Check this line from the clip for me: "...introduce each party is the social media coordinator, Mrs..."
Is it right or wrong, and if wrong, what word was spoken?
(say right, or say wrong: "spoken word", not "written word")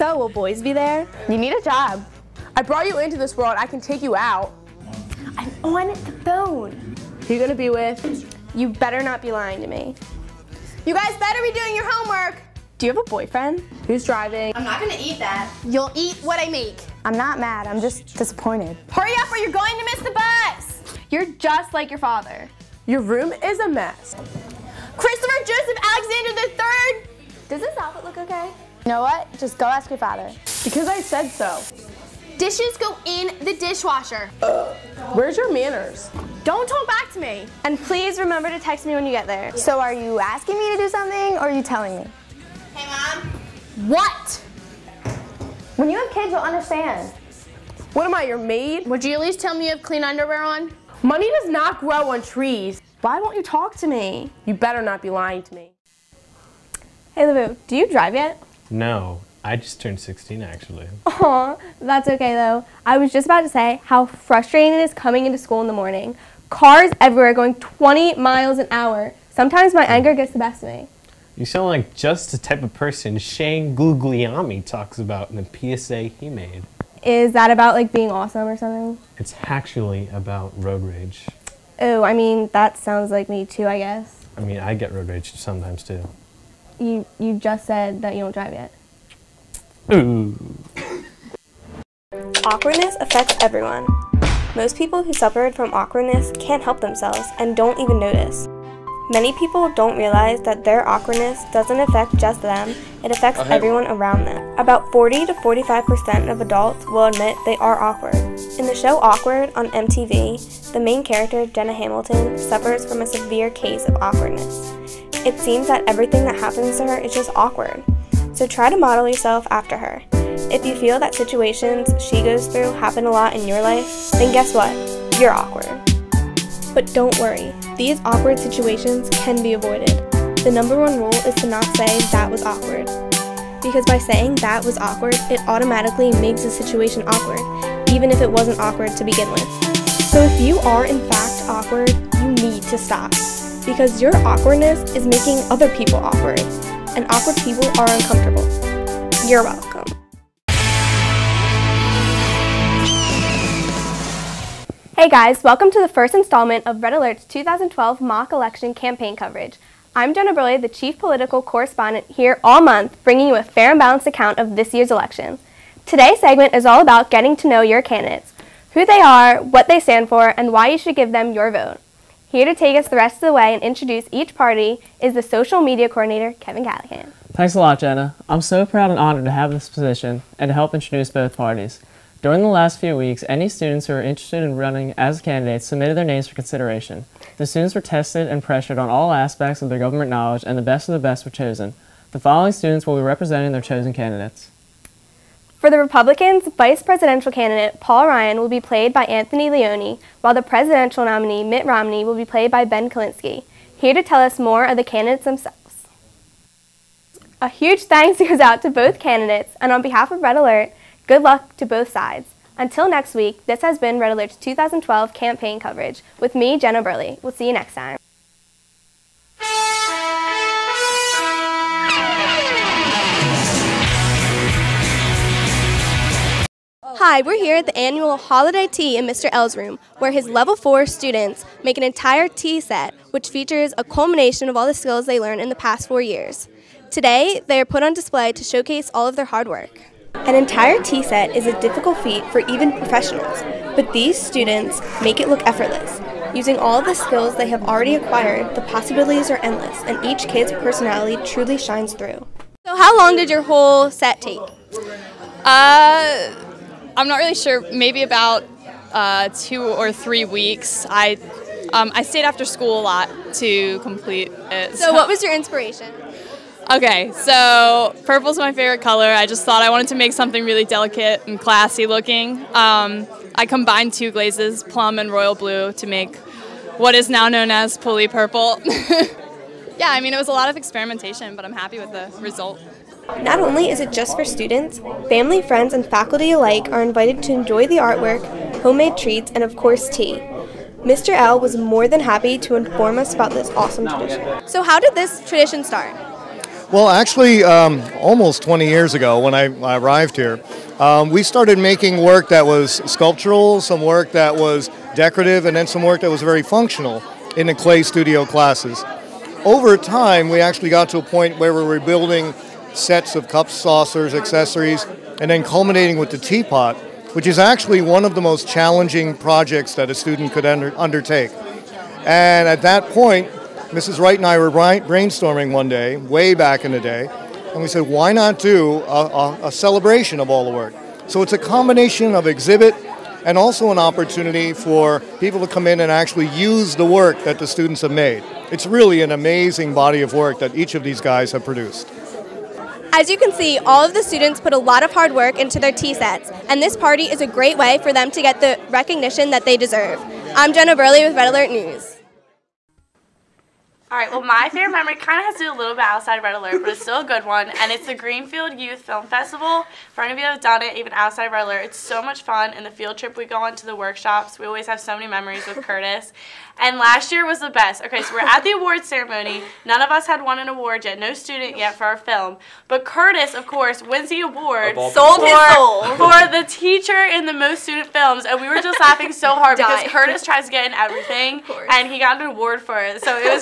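wrong: "Kevin", not "Mrs".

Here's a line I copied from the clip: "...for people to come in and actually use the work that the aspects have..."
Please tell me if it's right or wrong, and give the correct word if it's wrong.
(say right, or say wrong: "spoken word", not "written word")
wrong: "students", not "aspects".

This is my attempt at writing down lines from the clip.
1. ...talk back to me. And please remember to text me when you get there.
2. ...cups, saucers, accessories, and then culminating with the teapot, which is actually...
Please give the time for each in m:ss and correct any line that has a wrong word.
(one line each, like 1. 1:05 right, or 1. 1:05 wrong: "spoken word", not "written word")
1. 0:36 right
2. 5:13 right.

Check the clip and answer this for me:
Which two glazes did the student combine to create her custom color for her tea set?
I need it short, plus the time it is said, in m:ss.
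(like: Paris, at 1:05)
plum and royal blue, at 4:34.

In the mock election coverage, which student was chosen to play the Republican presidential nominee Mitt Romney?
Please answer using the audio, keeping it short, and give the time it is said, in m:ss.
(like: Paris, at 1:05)
Ben Kalinske, at 3:22.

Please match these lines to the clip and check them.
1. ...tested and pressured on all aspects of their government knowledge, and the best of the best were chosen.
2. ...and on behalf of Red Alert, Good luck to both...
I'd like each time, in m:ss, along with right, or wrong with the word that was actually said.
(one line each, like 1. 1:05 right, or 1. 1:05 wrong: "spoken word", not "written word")
1. 3:07 right
2. 3:29 right.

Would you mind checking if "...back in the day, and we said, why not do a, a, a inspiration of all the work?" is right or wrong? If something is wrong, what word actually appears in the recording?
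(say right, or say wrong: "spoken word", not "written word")
wrong: "celebration", not "inspiration".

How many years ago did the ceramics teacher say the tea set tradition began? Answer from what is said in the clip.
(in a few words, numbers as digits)
20 years.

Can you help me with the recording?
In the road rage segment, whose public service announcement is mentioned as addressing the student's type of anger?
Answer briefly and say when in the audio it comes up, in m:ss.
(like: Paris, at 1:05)
Shane Gugliami, at 1:13.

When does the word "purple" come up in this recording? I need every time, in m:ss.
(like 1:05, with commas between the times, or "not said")
4:28, 4:38.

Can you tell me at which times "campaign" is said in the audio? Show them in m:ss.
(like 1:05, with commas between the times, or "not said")
2:38, 3:35.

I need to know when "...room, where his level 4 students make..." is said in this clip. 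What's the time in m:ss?
3:49.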